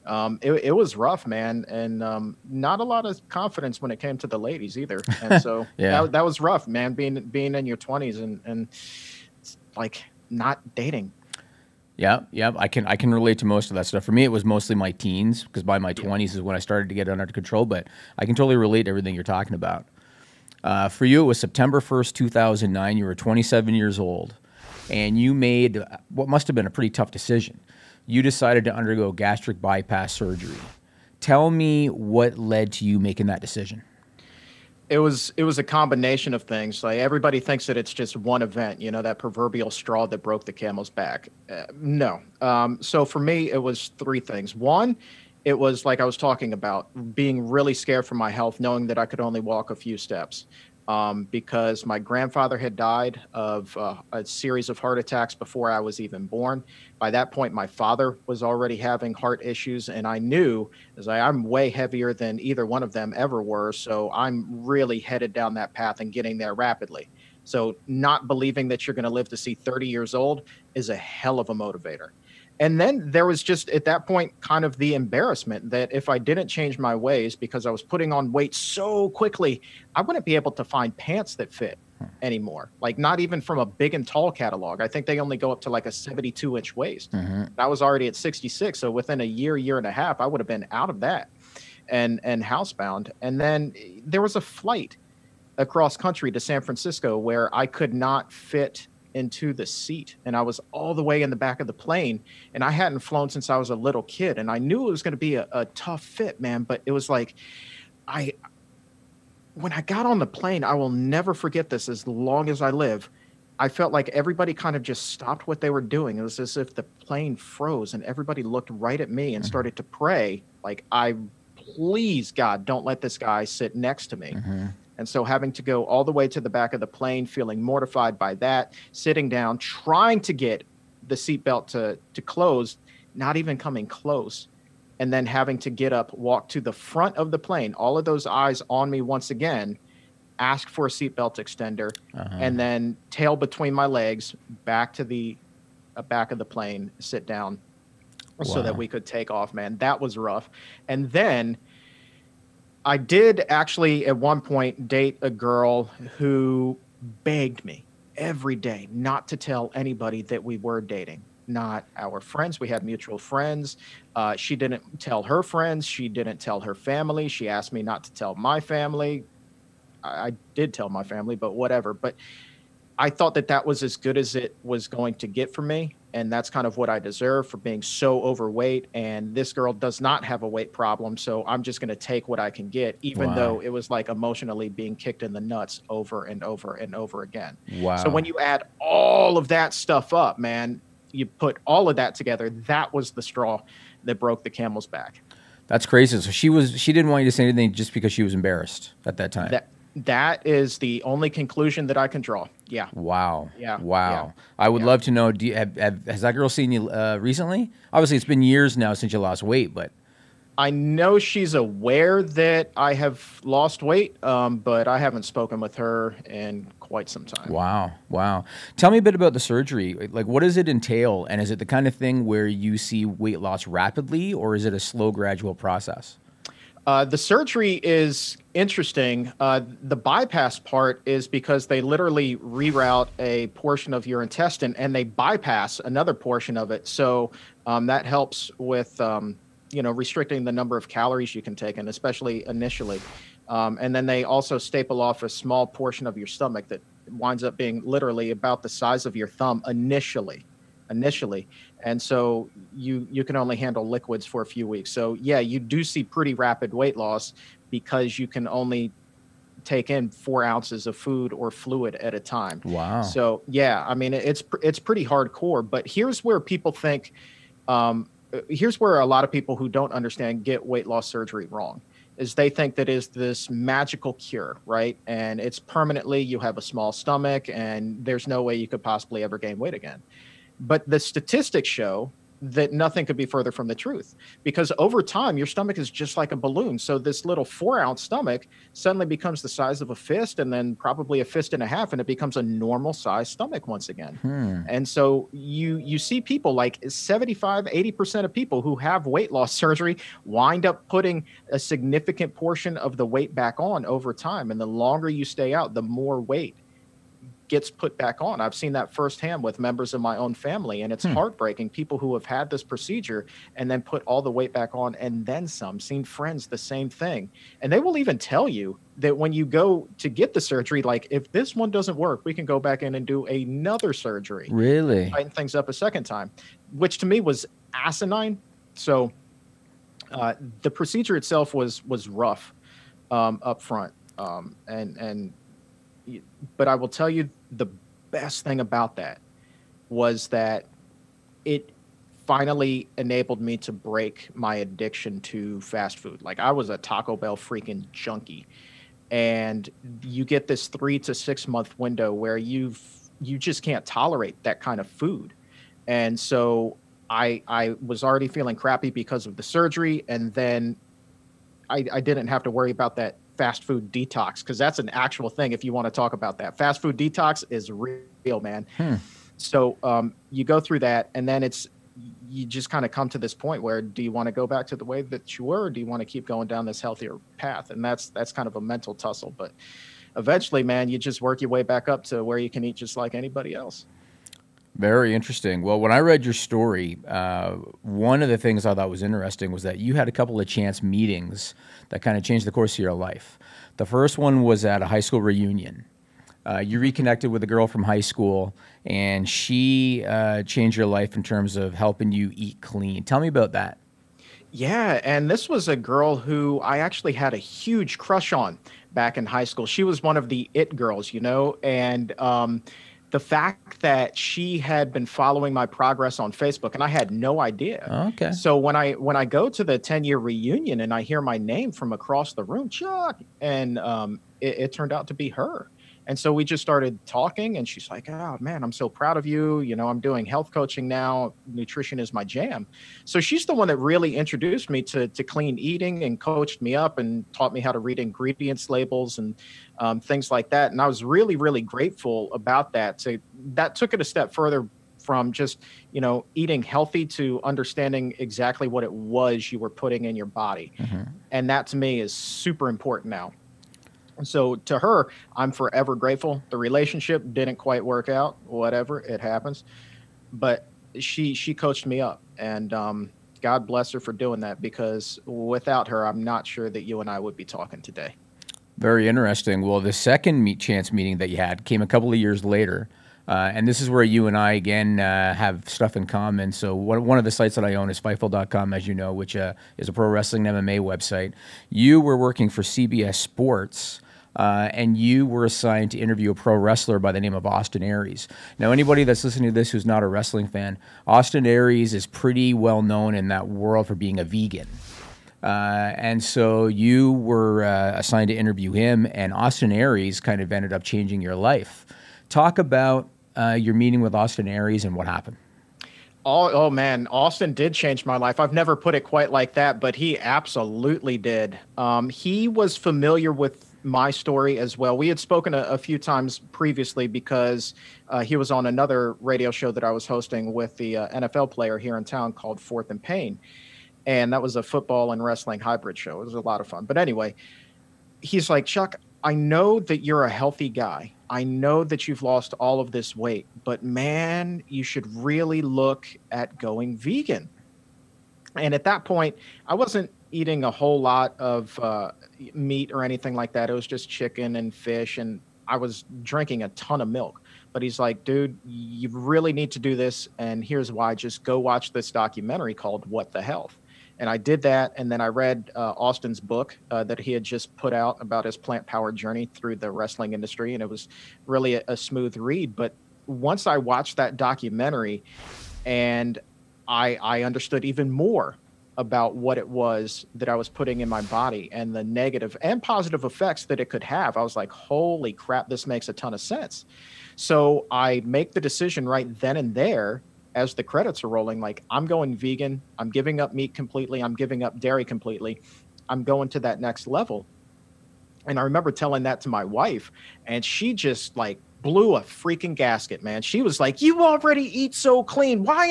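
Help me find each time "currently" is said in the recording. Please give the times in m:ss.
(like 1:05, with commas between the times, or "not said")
not said.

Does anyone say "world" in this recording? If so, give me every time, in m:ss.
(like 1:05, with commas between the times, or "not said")
8:13.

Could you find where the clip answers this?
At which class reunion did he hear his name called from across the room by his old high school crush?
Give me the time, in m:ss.
6:59.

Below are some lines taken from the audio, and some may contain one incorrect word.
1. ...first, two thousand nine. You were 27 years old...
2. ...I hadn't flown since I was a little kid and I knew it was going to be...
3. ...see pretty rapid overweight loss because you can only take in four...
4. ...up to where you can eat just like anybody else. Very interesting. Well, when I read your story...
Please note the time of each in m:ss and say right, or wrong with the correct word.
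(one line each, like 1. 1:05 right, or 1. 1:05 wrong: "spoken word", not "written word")
1. 0:21 right
2. 1:42 right
3. 4:15 wrong: "weight", not "overweight"
4. 6:21 right.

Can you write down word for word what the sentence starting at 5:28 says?
So uh, the procedure itself was was rough um, up front.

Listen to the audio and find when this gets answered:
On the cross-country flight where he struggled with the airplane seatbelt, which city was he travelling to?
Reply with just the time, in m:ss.
1:36.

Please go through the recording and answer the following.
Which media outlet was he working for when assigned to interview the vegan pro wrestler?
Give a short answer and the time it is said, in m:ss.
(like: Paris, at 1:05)
CBS Sports, at 8:02.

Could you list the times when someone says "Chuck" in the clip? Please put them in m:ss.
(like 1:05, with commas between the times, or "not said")
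7:02, 8:48.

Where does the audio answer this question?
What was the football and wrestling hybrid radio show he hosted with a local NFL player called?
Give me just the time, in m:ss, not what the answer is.
8:42.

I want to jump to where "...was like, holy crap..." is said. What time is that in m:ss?
9:34.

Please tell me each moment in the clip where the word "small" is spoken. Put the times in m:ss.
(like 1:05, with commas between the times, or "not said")
4:05, 4:36.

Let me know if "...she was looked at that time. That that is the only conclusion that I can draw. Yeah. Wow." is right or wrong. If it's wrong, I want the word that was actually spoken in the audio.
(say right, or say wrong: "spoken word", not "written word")
wrong: "embarrassed", not "looked".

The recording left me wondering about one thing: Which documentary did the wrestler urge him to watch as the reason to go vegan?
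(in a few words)
What the Health.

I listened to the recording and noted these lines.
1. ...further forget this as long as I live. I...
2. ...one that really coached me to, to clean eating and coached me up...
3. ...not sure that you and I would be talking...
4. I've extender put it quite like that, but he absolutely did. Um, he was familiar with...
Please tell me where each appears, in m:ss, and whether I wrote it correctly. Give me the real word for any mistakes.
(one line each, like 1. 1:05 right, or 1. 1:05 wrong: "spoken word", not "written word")
1. 1:50 wrong: "never", not "further"
2. 7:13 wrong: "introduced", not "coached"
3. 7:46 right
4. 8:28 wrong: "never", not "extender".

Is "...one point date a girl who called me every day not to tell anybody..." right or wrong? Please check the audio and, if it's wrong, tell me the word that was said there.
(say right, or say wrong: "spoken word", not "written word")
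wrong: "begged", not "called".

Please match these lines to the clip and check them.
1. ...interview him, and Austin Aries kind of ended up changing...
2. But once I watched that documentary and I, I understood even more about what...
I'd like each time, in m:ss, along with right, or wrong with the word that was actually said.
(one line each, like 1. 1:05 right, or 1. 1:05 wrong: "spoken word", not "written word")
1. 8:18 right
2. 9:22 right.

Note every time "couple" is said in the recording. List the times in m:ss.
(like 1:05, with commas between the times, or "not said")
6:30, 7:51.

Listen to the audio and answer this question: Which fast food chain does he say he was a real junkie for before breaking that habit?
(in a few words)
Taco Bell.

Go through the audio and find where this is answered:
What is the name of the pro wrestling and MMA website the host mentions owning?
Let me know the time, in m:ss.
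7:57.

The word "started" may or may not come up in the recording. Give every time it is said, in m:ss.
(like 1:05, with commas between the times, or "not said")
0:16, 1:59, 7:06.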